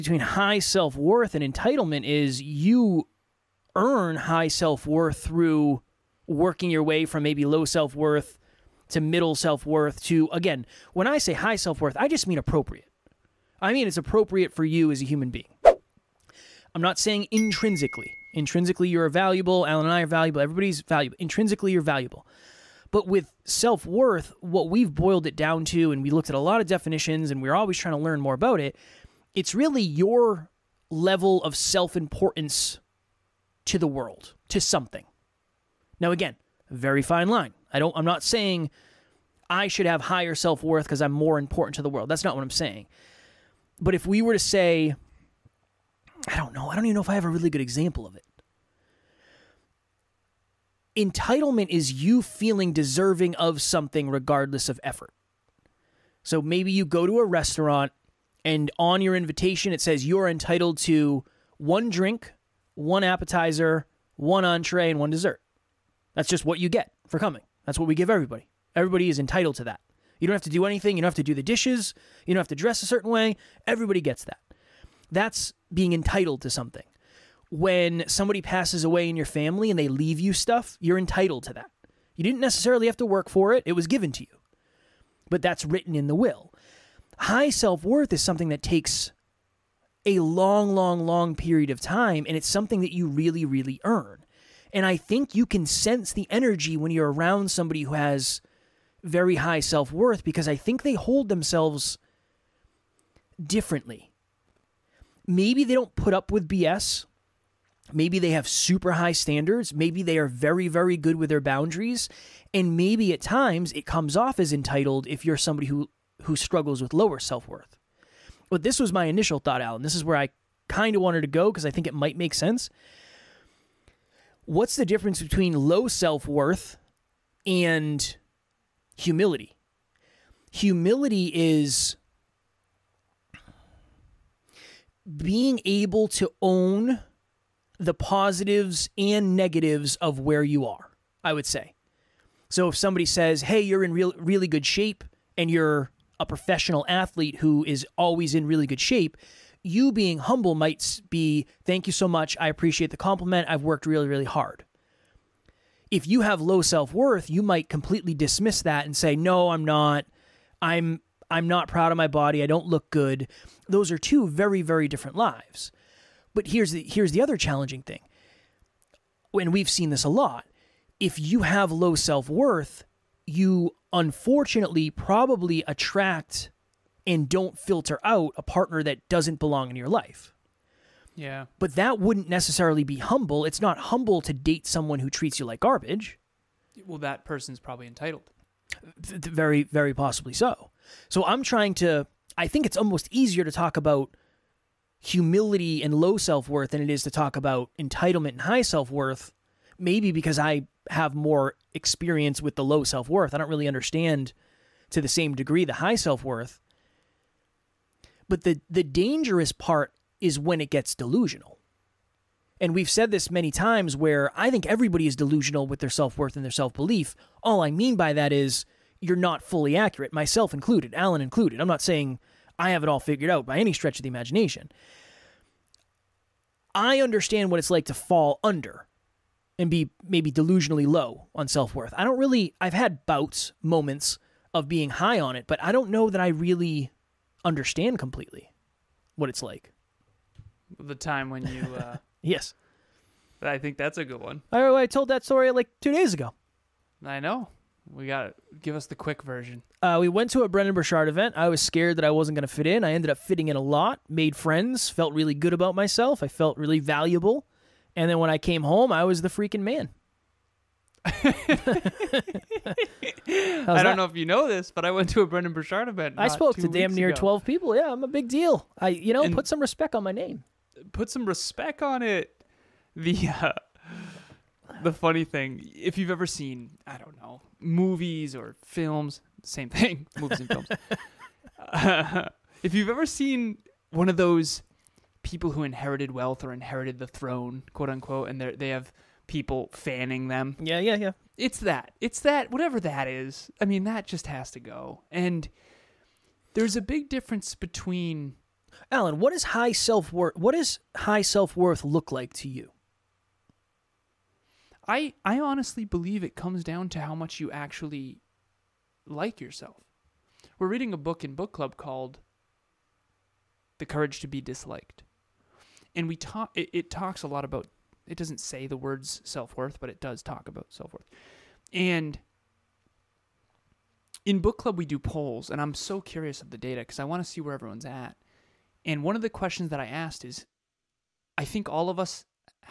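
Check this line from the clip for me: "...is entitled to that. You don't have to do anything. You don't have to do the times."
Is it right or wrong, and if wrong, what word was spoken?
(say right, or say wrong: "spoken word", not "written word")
wrong: "dishes", not "times".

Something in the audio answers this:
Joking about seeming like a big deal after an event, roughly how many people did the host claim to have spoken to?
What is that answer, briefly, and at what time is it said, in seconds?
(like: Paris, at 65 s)
12, at 267 s.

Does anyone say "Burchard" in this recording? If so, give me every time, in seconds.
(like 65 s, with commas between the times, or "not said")
250 s, 265 s.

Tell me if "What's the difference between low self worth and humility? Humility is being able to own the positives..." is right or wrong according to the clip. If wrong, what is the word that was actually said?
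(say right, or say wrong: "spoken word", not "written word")
right.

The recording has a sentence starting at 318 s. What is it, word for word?
It doesn't say the words self worth, but it does talk about self worth.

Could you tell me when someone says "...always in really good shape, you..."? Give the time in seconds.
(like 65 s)
147 s.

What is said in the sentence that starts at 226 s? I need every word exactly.
I understand what it's like to fall under and be maybe delusionally low on self worth.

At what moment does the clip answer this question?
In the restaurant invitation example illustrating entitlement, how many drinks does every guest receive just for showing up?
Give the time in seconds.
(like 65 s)
61 s.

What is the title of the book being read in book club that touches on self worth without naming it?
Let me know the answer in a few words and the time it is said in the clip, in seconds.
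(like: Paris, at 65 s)
The Courage to be Disliked, at 313 s.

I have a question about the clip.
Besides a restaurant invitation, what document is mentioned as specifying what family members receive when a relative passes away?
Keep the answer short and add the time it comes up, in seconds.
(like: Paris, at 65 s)
The will, at 86 s.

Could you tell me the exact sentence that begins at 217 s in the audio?
All I mean by that is you're not fully accurate, myself included, Alan included.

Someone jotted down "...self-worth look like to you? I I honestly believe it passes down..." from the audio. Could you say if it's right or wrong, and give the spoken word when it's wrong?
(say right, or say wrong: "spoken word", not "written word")
wrong: "comes", not "passes".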